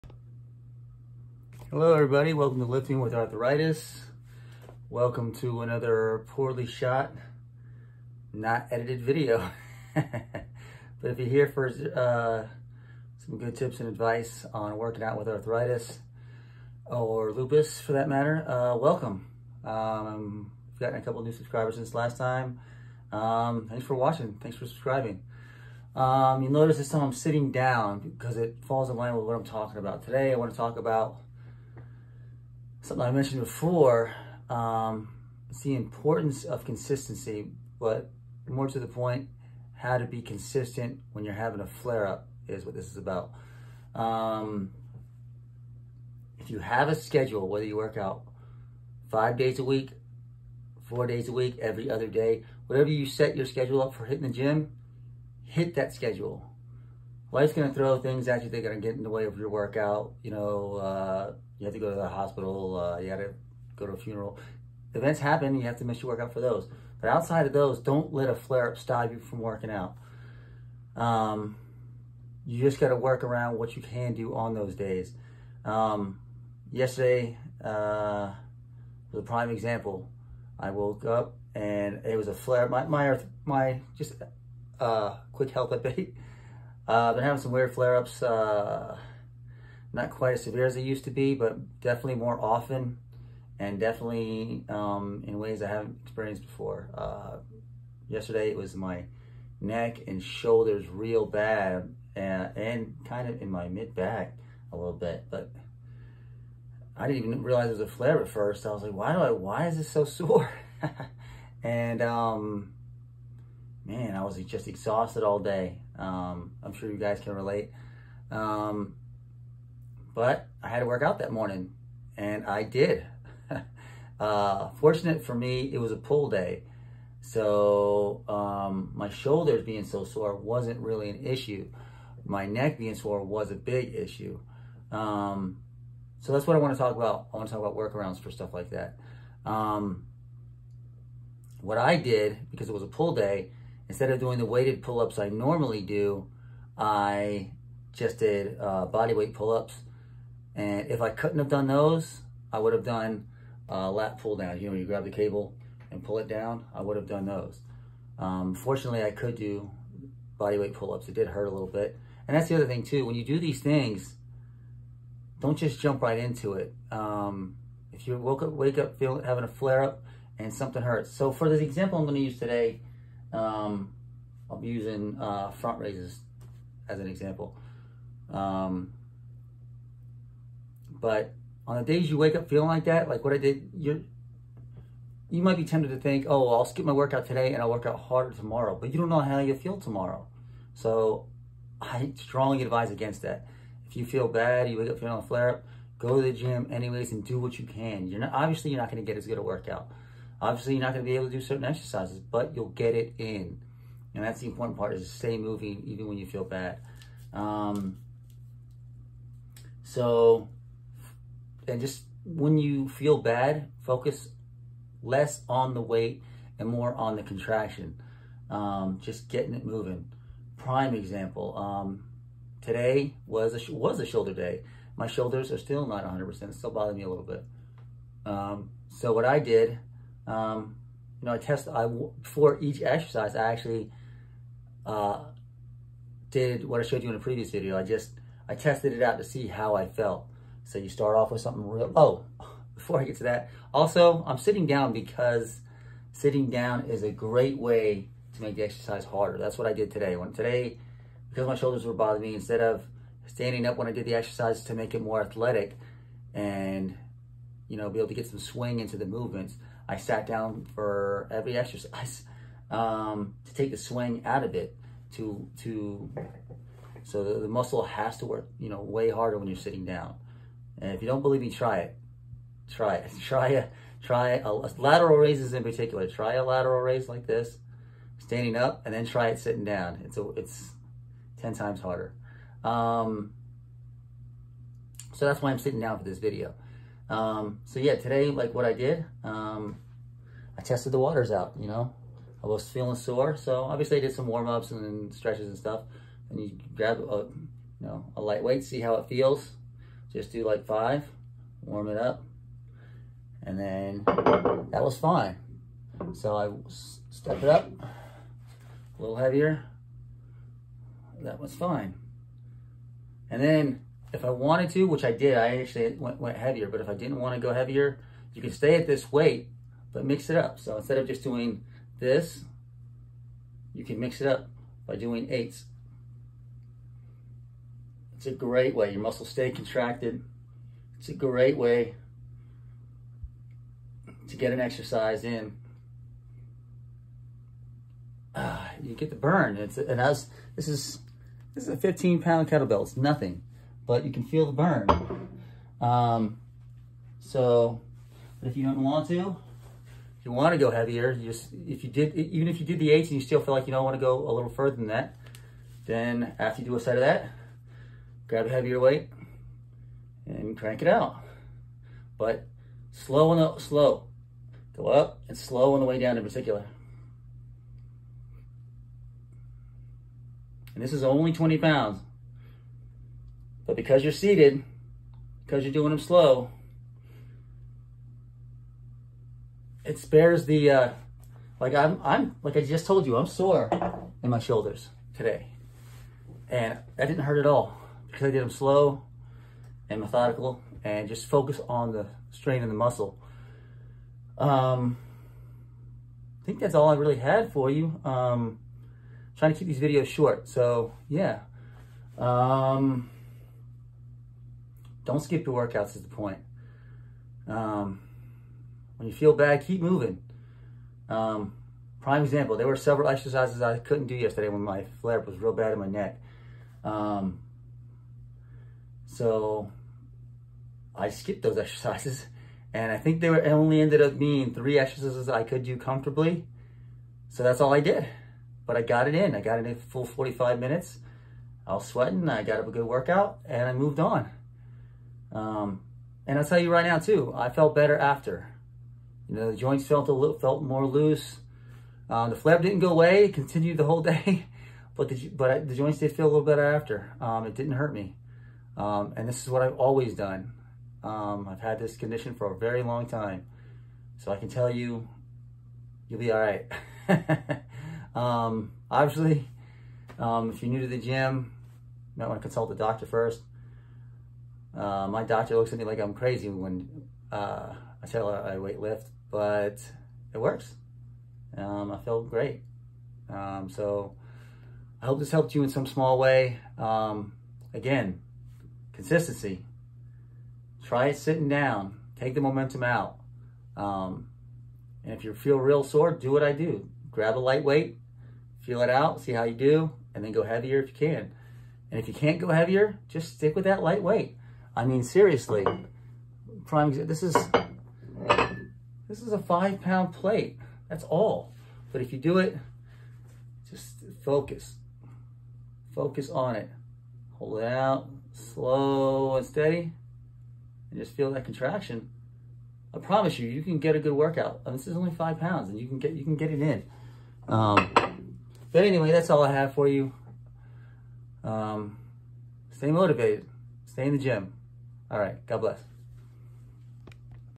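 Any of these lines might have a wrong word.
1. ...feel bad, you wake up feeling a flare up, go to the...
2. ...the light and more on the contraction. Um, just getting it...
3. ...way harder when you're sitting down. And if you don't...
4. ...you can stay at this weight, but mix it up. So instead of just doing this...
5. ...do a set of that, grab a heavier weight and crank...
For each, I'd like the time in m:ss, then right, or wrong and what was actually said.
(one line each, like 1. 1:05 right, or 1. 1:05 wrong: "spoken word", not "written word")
1. 3:14 right
2. 3:35 wrong: "weight", not "light"
3. 4:28 right
4. 5:18 right
5. 5:56 right.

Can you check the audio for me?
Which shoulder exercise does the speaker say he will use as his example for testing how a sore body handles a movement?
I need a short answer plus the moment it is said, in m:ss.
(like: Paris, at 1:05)
Front raises, at 2:55.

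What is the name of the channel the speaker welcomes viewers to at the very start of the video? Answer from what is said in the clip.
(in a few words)
Lifting with Arthritis.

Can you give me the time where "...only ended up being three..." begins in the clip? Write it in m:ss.
7:03.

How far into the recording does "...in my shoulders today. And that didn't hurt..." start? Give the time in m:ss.
6:24.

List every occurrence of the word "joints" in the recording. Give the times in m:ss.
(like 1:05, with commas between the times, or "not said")
7:19, 7:25.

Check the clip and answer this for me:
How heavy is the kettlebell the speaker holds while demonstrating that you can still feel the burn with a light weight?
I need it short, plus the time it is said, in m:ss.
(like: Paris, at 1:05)
15 pounds, at 5:41.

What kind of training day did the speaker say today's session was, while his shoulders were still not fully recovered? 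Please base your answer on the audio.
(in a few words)
Shoulder day.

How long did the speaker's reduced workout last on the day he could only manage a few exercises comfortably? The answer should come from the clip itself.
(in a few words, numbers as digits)
45 minutes.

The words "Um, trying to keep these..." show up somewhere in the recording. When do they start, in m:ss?
6:38.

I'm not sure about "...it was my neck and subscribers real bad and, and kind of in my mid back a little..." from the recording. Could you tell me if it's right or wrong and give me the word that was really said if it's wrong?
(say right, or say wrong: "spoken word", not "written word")
wrong: "shoulders", not "subscribers".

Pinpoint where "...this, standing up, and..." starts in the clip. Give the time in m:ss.
4:37.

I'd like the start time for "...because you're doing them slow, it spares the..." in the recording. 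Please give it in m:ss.
6:15.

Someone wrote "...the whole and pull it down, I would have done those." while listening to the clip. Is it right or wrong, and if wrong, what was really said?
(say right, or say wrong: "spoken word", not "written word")
wrong: "cable", not "whole".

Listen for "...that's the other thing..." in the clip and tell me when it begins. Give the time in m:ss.
2:42.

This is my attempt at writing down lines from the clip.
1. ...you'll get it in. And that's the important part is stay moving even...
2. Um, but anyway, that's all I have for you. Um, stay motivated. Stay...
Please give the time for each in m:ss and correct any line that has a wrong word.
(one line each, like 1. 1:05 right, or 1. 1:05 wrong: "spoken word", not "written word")
1. 3:22 right
2. 8:37 right.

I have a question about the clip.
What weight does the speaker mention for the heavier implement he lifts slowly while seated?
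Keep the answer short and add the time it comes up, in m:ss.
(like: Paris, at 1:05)
20 pounds, at 6:11.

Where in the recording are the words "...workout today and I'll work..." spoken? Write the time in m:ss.
3:06.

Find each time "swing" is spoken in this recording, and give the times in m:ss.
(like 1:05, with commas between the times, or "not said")
4:18, 4:23.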